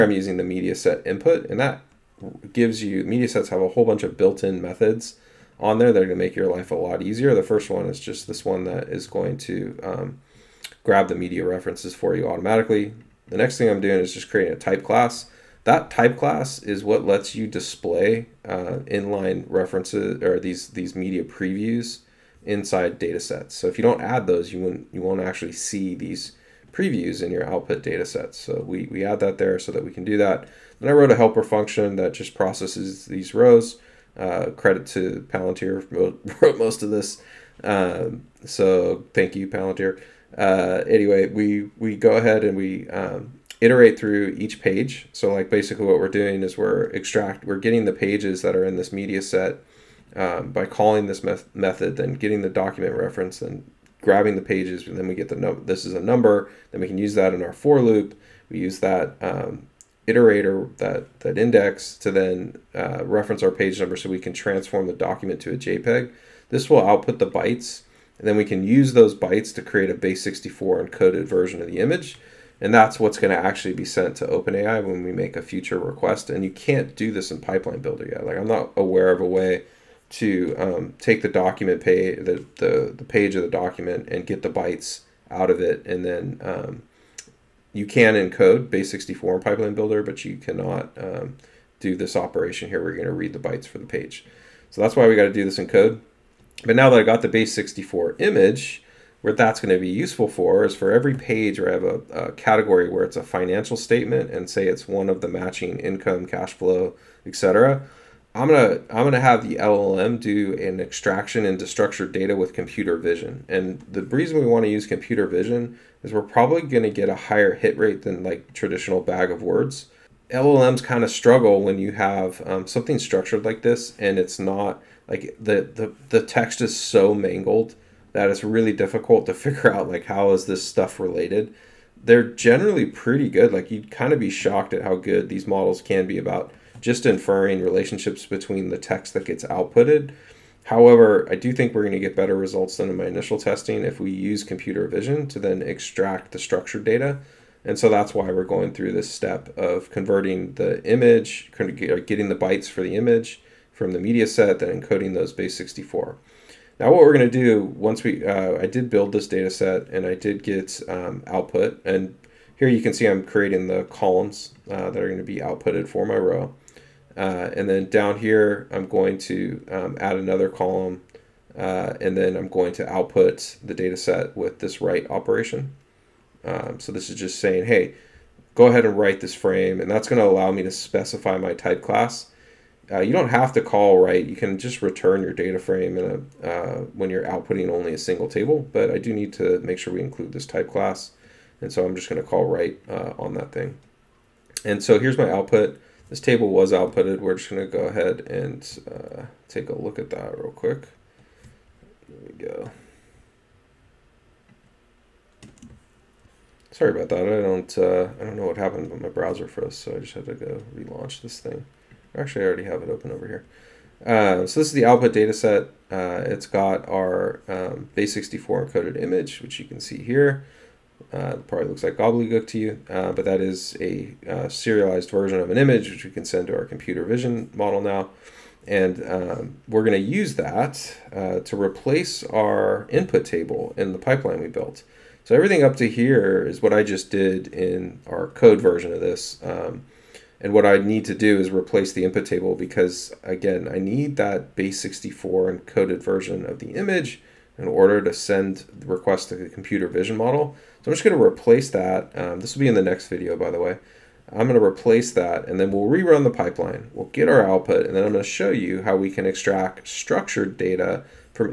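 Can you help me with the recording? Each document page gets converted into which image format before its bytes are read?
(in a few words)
JPEG.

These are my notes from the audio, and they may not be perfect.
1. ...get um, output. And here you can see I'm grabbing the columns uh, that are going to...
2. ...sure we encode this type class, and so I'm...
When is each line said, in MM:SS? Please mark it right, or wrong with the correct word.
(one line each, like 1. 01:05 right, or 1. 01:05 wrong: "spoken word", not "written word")
1. 02:40 wrong: "creating", not "grabbing"
2. 03:09 wrong: "include", not "encode".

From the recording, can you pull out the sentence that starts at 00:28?
So we, we add that there so that we can do that.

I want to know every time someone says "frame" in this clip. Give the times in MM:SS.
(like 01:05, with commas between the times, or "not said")
02:59, 03:05.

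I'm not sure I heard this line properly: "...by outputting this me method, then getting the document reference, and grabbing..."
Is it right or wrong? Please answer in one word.
wrong.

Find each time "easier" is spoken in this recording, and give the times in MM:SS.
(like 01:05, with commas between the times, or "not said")
00:07.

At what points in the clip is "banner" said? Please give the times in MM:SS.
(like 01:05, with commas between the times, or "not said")
not said.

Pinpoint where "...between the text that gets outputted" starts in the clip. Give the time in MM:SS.
02:18.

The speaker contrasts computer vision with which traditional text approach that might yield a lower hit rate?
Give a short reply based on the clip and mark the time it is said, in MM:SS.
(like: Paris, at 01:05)
bag of words, at 01:59.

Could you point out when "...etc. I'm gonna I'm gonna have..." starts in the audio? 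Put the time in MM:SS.
01:47.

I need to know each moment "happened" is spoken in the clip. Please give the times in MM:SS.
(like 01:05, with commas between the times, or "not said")
03:28.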